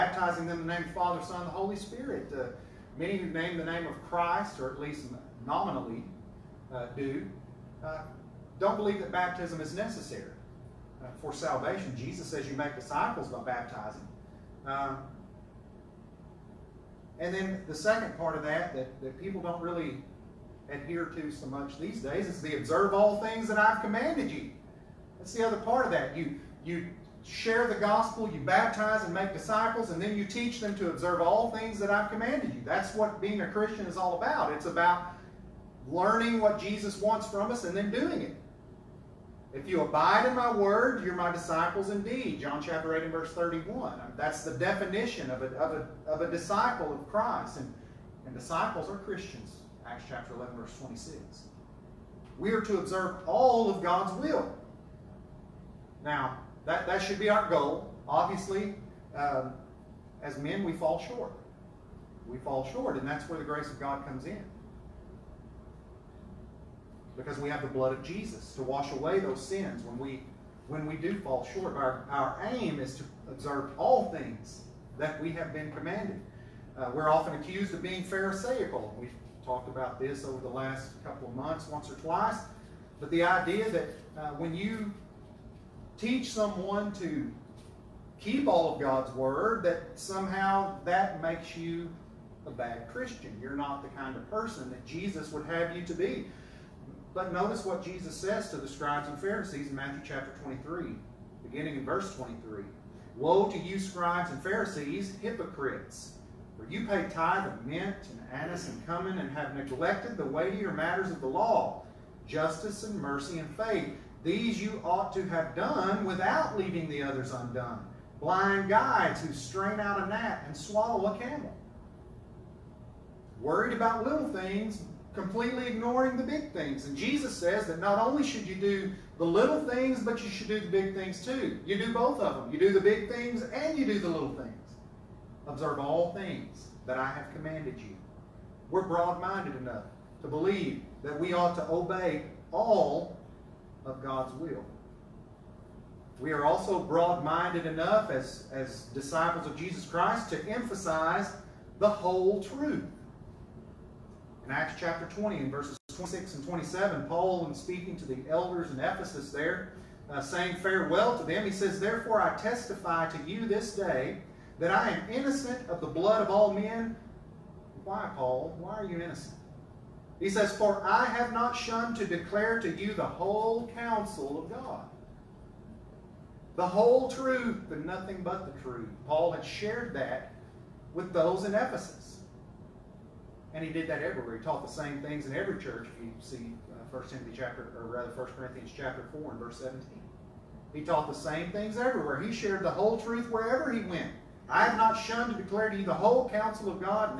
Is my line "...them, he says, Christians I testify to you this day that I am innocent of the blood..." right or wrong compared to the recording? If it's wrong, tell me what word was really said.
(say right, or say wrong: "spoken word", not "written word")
wrong: "Therefore", not "Christians".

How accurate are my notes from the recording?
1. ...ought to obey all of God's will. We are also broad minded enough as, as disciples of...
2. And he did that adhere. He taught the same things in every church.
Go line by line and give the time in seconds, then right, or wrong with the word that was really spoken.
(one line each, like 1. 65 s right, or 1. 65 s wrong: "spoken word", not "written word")
1. 141 s right
2. 183 s wrong: "everywhere", not "adhere".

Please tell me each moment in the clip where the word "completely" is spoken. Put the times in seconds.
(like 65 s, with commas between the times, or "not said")
125 s.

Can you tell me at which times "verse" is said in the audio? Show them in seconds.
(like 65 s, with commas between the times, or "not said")
43 s, 50 s, 101 s, 155 s, 189 s.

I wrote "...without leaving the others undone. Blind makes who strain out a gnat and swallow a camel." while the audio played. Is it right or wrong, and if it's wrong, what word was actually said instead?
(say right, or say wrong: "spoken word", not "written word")
wrong: "guides", not "makes".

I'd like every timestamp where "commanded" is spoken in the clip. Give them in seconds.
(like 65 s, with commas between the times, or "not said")
23 s, 32 s, 75 s, 137 s.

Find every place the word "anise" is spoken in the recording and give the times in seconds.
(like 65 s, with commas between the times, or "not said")
108 s.